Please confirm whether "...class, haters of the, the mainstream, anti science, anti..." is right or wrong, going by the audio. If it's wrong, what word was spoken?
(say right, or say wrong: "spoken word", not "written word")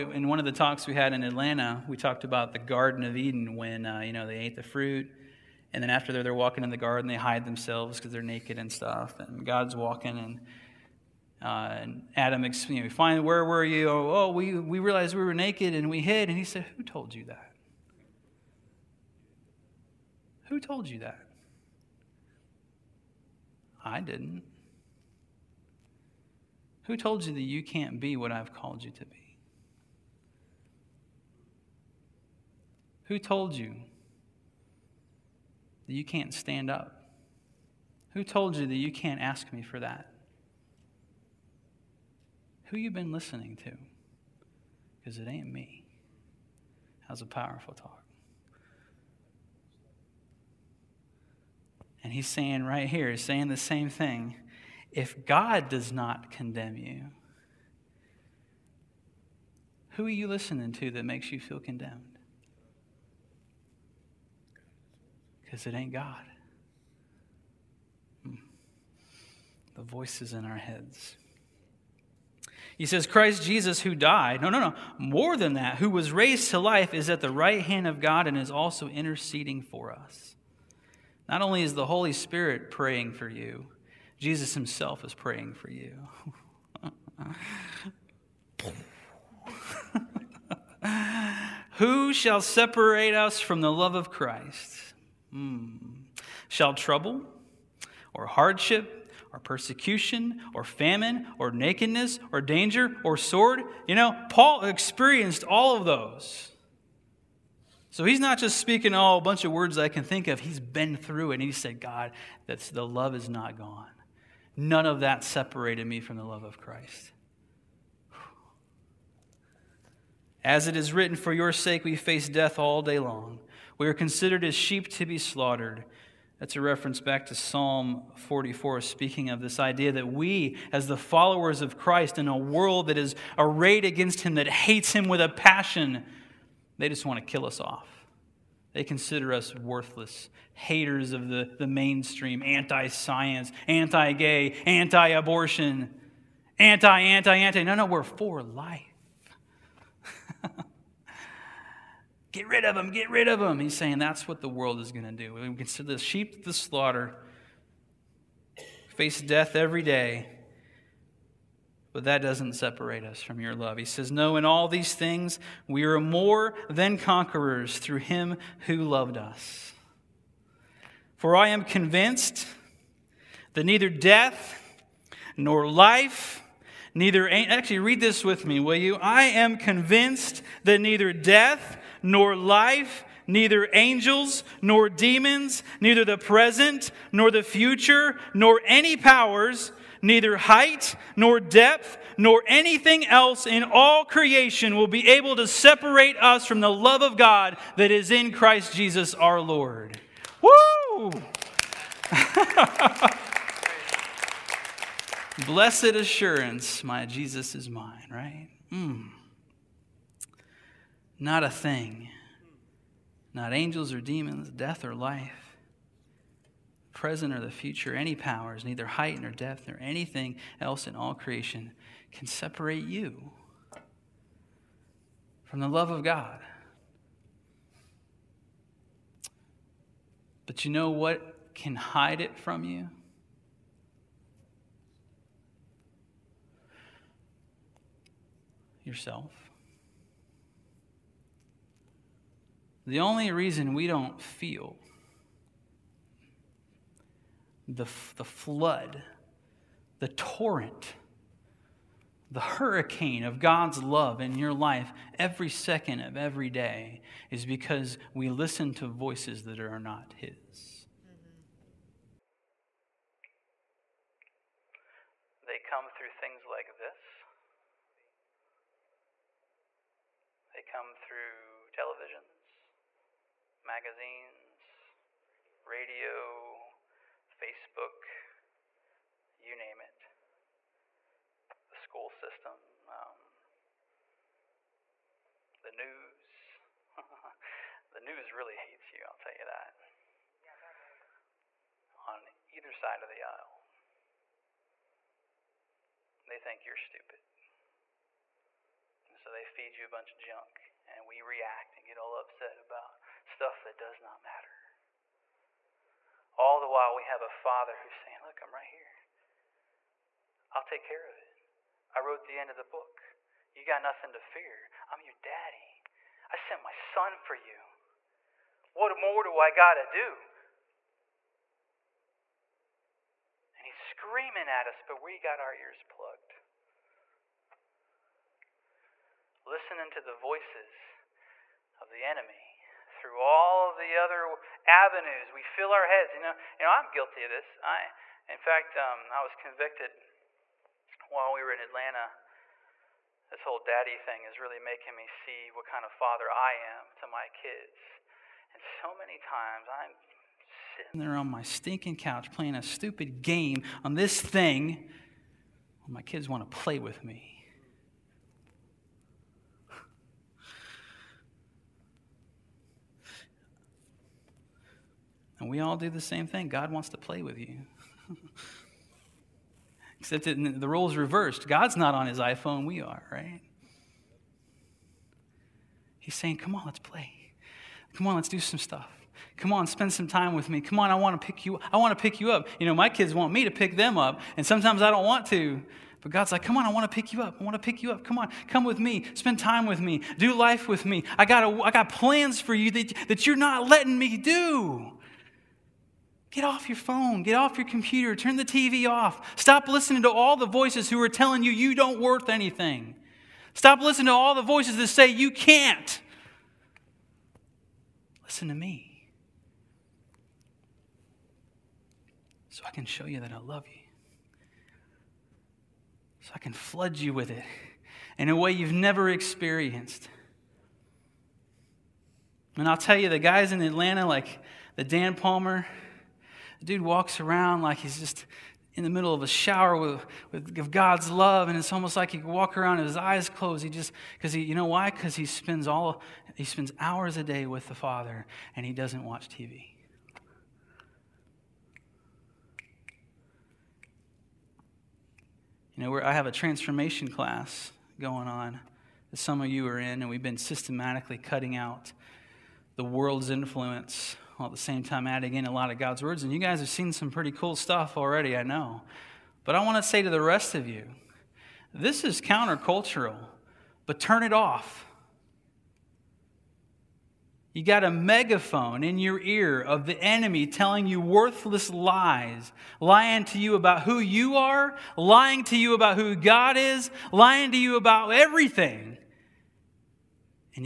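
wrong: "worthless", not "class".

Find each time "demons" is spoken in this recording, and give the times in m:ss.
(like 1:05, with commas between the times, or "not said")
3:04, 3:34.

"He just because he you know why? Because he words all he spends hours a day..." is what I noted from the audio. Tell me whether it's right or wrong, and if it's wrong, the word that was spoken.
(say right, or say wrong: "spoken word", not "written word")
wrong: "spends", not "words".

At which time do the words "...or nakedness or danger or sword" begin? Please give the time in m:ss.
1:41.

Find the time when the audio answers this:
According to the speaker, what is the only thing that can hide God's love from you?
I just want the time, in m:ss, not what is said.
3:58.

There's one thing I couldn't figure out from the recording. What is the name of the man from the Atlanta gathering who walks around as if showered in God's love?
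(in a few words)
Dan Palmer.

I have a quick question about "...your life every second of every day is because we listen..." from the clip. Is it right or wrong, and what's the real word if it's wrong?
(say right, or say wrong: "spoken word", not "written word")
right.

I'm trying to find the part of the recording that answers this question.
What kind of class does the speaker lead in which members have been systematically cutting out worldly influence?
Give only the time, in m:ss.
7:26.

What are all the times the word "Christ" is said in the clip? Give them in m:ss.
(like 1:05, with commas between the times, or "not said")
1:13, 1:34, 1:56, 2:11, 3:18.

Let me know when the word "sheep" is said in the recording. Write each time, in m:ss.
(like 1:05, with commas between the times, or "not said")
2:04, 2:35.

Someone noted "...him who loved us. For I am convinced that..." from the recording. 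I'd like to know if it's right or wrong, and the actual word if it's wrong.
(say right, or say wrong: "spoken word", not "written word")
right.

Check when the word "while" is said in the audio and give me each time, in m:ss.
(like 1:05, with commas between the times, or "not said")
5:06, 5:41, 7:34.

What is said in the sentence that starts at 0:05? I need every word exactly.
And then after they're, walking in the garden, they hide themselves because they're naked and stuff.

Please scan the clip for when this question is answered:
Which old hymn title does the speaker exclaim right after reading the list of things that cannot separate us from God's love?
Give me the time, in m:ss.
3:25.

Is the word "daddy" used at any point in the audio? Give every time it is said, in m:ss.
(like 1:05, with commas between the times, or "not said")
5:15, 5:43.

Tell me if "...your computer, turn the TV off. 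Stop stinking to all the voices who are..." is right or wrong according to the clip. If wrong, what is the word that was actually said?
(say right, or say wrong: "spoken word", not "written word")
wrong: "listening", not "stinking".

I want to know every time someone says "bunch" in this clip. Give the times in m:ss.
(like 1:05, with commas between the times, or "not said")
1:49, 4:59.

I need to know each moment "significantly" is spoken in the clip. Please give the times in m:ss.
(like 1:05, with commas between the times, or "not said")
not said.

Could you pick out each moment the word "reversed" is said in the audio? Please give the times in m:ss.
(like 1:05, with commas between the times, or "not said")
6:10.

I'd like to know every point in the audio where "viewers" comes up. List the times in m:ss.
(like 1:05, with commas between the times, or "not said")
not said.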